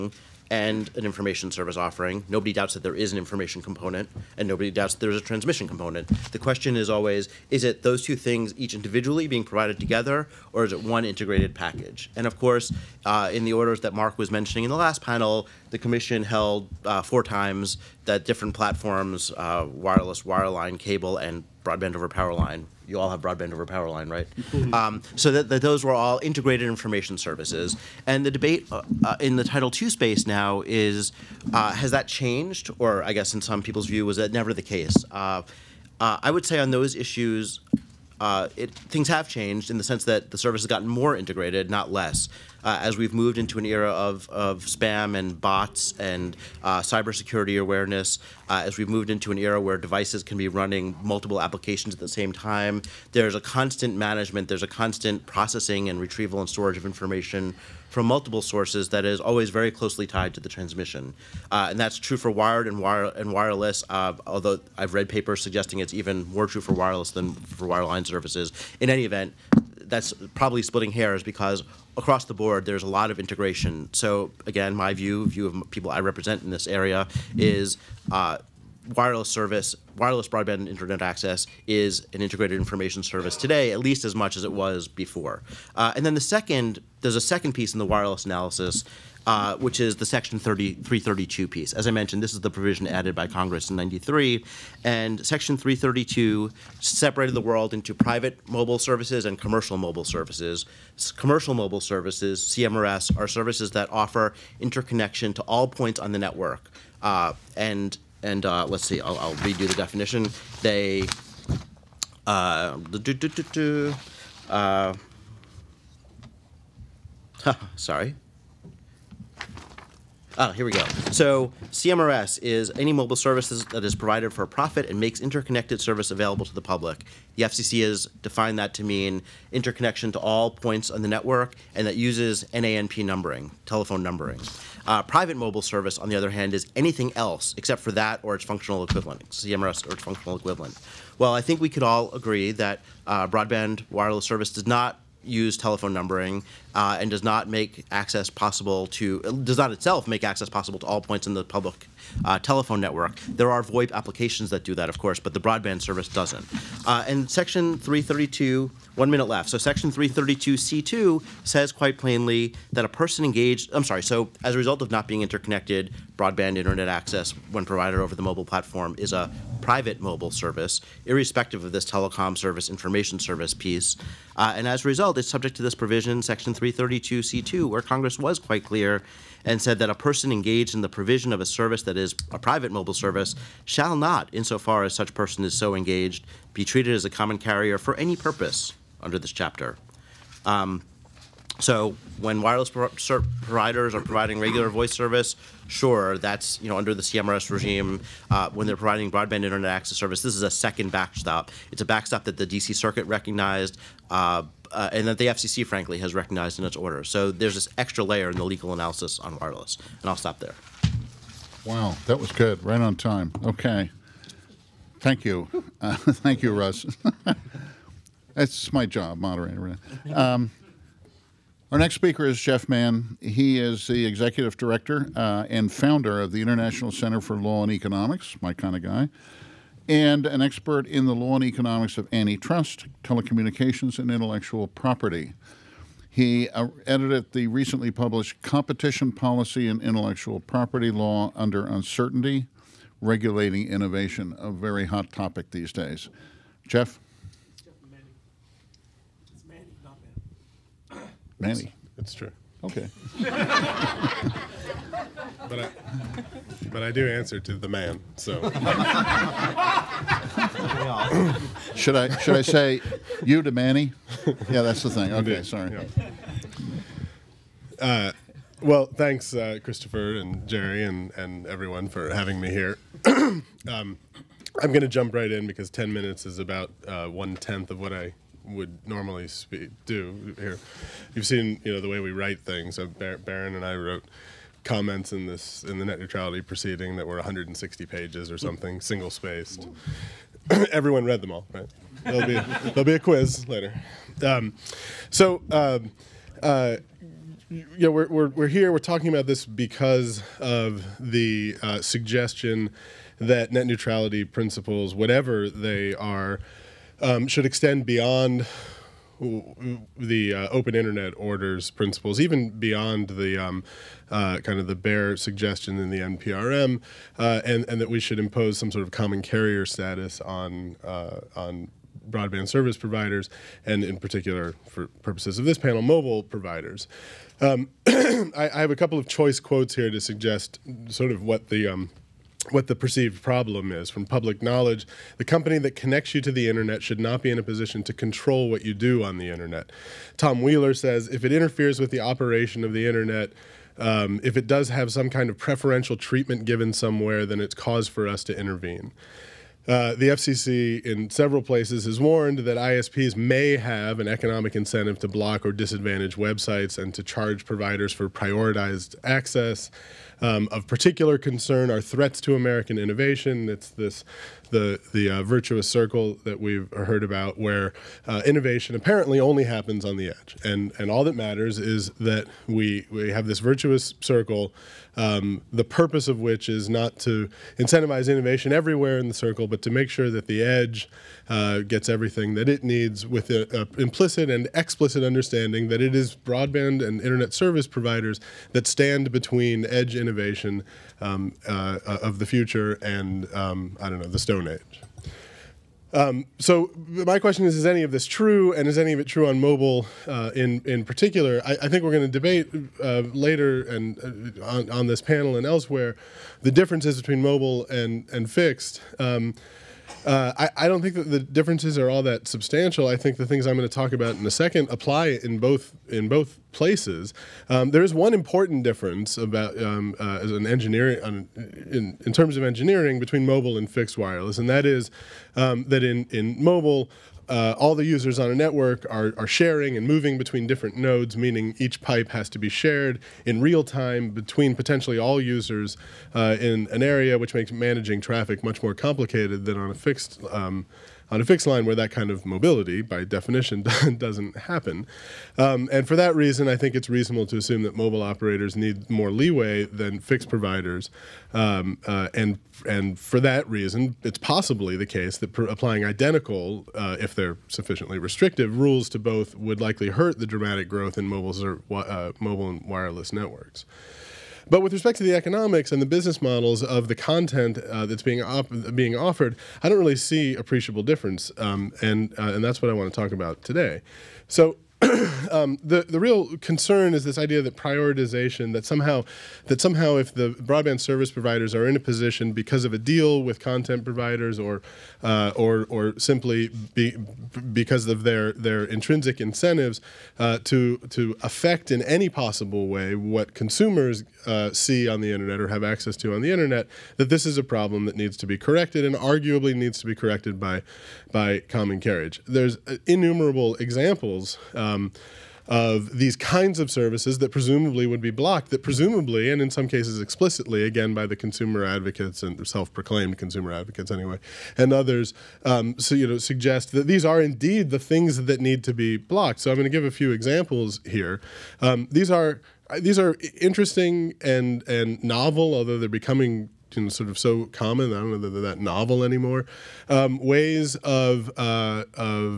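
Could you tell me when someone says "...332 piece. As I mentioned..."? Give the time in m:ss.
1:30.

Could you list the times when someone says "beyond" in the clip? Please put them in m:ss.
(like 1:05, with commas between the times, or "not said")
5:07, 5:12.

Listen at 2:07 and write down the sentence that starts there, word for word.
The FCC has defined that to mean interconnection to all points on the network and that uses NANP numbering, telephone numbering.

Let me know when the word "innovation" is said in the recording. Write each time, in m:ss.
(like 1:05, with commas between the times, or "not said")
4:03, 6:02, 6:08, 6:18, 6:29.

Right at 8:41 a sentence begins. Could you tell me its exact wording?
Um, these are these are interesting and and novel, although they're becoming you know, sort of so common.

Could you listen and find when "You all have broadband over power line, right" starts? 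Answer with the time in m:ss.
0:22.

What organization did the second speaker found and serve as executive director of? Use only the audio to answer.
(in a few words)
International Center for Law and Economics.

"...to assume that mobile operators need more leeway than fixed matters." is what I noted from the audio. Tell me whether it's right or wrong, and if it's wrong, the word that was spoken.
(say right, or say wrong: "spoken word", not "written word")
wrong: "providers", not "matters".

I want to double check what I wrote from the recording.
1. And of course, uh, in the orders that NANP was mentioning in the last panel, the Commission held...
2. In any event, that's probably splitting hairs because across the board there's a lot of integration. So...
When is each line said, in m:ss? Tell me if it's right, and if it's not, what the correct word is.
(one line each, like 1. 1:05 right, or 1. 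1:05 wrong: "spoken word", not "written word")
1. 0:12 wrong: "Mark", not "NANP"
2. 1:08 right.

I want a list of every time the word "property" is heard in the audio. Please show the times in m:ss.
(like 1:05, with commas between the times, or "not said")
3:54, 4:00.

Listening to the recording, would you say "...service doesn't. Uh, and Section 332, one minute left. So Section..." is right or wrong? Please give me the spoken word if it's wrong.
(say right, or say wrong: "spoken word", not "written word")
right.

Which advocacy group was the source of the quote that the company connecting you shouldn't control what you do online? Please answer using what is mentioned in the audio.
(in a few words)
Public Knowledge.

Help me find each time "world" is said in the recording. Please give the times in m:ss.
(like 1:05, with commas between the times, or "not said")
1:37.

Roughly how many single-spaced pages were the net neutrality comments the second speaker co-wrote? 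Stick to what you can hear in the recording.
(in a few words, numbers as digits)
160.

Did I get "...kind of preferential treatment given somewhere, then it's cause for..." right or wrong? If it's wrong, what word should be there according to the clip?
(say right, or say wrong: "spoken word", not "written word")
right.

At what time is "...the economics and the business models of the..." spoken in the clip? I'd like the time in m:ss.
7:45.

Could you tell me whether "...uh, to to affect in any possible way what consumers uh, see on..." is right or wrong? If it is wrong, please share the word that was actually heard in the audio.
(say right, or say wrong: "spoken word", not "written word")
right.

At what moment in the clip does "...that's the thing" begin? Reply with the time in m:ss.
4:24.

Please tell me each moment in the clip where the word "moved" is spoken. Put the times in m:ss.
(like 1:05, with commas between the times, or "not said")
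0:43, 0:48.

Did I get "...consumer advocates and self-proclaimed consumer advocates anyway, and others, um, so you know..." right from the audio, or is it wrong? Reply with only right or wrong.
right.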